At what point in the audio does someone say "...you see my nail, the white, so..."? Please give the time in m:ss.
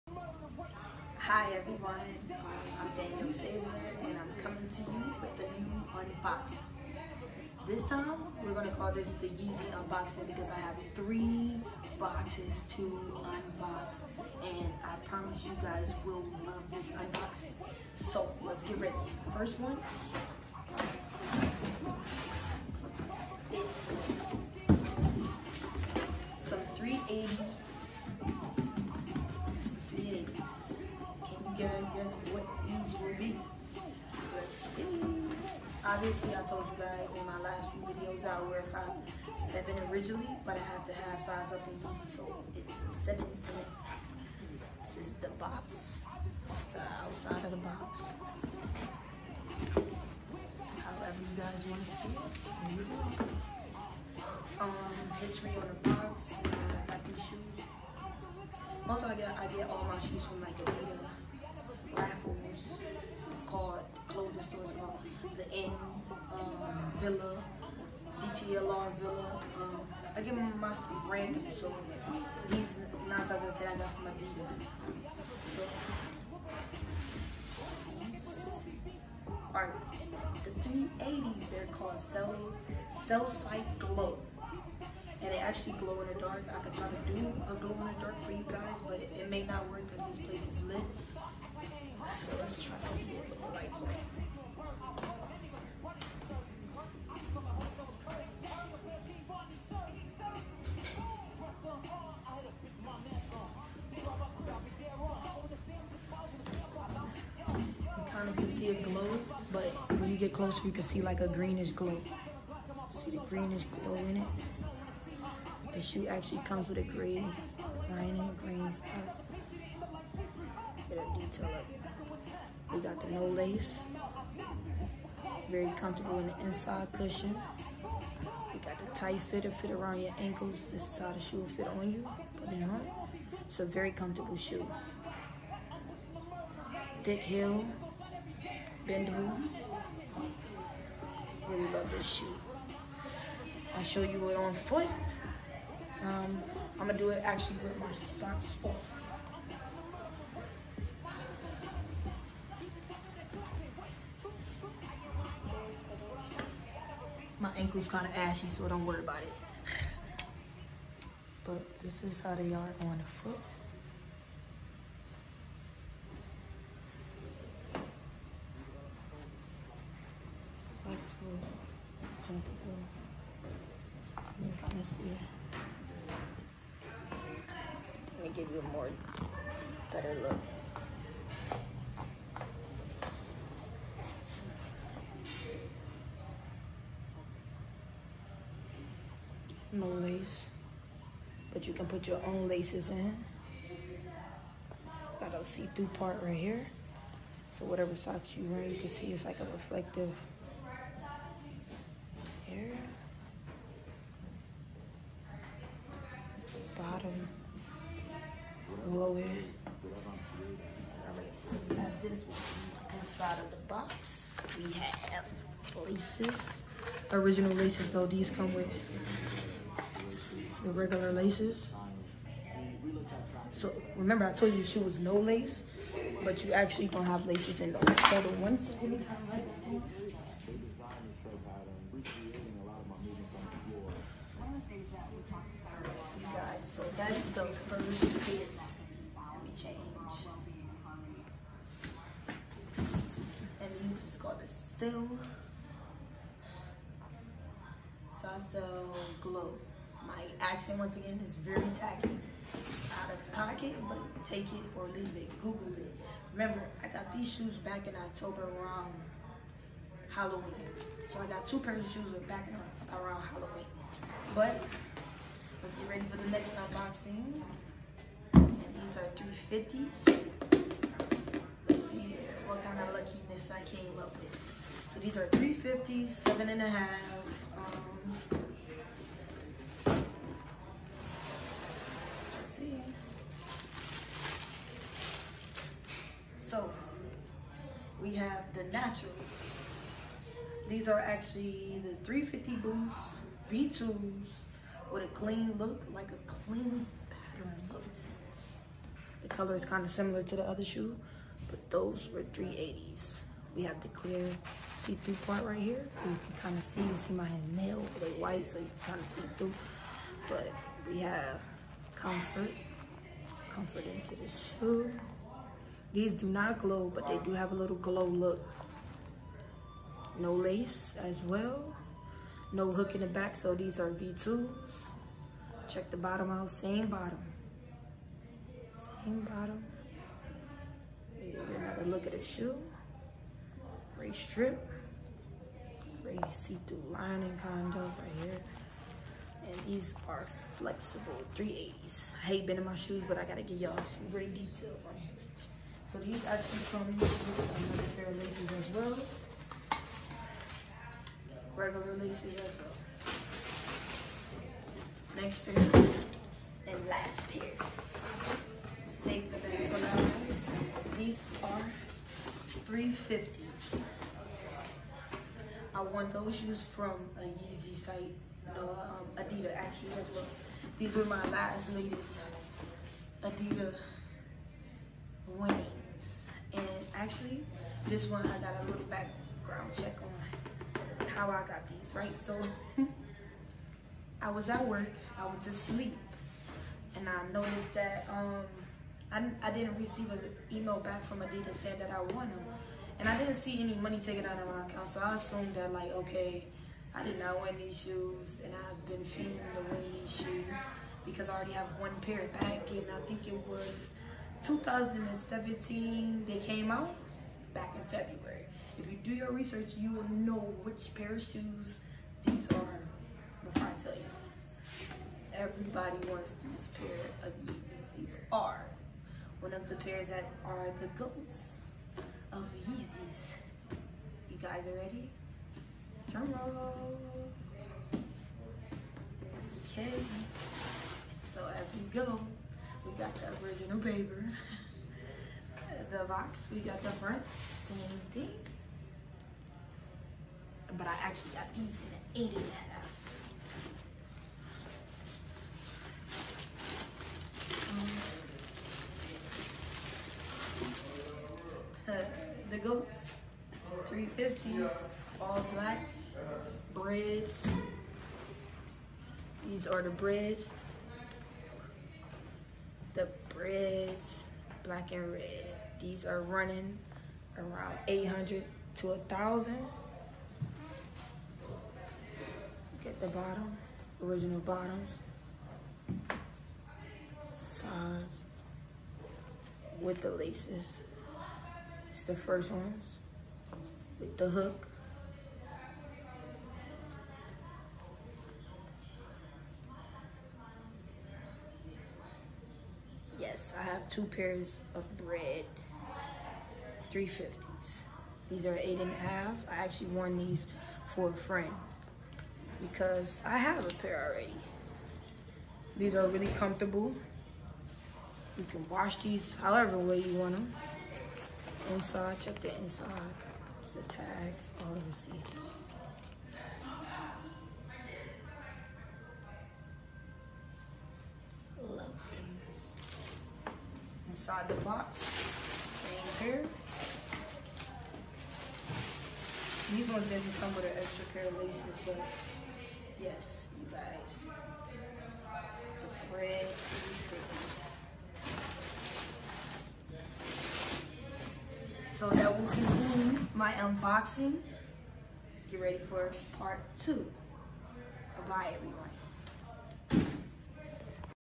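5:06.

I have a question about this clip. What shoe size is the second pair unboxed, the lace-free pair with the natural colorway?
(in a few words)
7 and a half.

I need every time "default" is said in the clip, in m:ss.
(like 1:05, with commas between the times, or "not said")
not said.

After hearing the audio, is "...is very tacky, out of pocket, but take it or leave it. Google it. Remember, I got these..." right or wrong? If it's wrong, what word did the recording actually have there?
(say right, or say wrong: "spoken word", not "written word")
right.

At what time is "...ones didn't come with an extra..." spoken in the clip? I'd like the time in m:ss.
8:49.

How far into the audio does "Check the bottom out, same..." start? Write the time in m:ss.
5:25.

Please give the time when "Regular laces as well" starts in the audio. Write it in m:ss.
5:51.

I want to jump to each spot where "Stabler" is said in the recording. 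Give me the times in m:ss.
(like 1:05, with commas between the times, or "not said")
0:03.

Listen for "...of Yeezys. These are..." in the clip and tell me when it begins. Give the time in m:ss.
6:57.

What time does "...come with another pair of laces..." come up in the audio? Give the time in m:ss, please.
5:46.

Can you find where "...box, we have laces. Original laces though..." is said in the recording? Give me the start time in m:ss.
3:33.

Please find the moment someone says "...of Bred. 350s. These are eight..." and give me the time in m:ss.
8:14.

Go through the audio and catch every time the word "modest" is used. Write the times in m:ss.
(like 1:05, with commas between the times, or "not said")
not said.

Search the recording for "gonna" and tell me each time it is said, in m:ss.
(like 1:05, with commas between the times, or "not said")
0:08, 2:26.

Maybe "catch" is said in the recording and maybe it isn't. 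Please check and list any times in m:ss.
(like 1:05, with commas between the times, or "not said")
not said.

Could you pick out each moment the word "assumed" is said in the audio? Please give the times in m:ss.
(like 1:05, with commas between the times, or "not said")
6:35.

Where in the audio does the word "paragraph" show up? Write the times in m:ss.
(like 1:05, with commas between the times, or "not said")
not said.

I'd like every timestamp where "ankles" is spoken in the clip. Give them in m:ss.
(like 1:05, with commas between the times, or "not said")
2:10, 2:37.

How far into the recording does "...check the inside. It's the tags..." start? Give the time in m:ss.
8:32.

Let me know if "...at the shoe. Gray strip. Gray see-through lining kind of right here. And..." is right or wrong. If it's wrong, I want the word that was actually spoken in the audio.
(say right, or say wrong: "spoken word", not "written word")
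right.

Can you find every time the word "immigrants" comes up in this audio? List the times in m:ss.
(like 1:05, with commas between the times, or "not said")
not said.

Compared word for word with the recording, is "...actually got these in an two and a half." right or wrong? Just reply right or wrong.
wrong.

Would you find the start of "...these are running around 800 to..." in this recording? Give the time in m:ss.
7:45.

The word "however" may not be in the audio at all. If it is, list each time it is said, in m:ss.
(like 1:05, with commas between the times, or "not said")
0:50, 8:29.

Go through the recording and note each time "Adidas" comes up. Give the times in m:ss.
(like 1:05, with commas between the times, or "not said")
1:00, 1:14, 6:09, 6:13, 6:31.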